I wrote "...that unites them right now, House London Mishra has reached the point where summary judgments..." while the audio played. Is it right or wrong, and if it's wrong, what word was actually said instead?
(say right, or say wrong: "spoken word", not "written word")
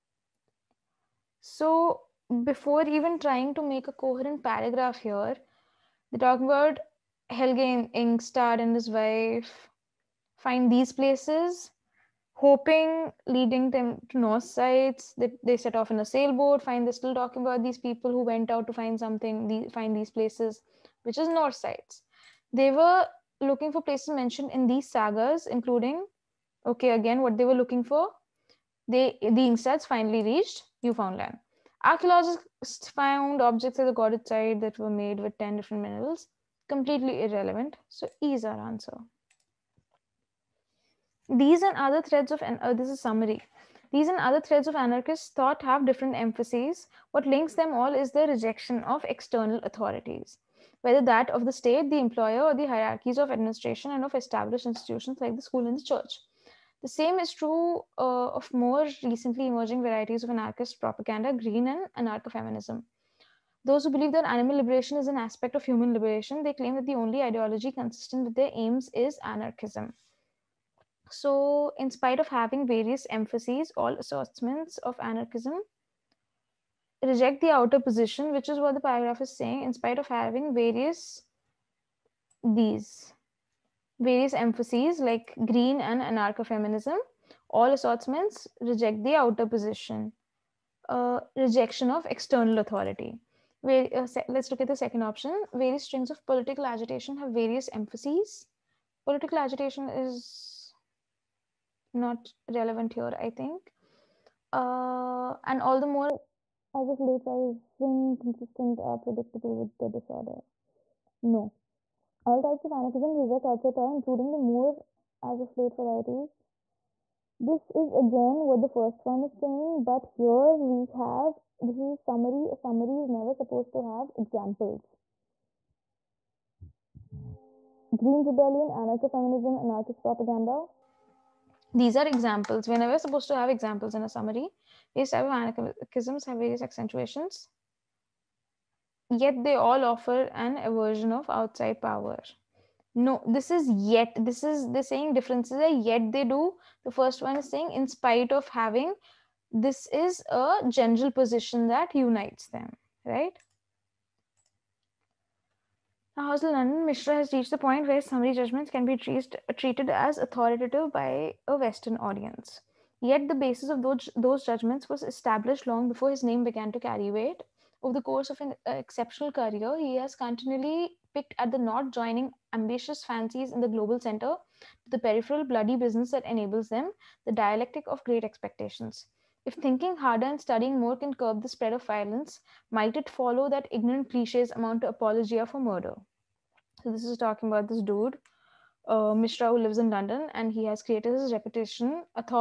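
right.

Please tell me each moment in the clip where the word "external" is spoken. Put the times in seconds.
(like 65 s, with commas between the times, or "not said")
49 s, 92 s.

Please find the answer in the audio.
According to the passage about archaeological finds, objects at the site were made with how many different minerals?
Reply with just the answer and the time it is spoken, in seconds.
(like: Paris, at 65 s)
10, at 35 s.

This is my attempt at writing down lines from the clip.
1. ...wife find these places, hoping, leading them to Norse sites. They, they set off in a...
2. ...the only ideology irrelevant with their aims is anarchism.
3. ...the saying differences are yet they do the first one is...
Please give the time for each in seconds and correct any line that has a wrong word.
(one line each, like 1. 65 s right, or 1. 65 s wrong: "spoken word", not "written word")
1. 8 s right
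2. 66 s wrong: "consistent", not "irrelevant"
3. 144 s right.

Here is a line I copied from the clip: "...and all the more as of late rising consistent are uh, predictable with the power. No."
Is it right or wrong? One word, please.
wrong.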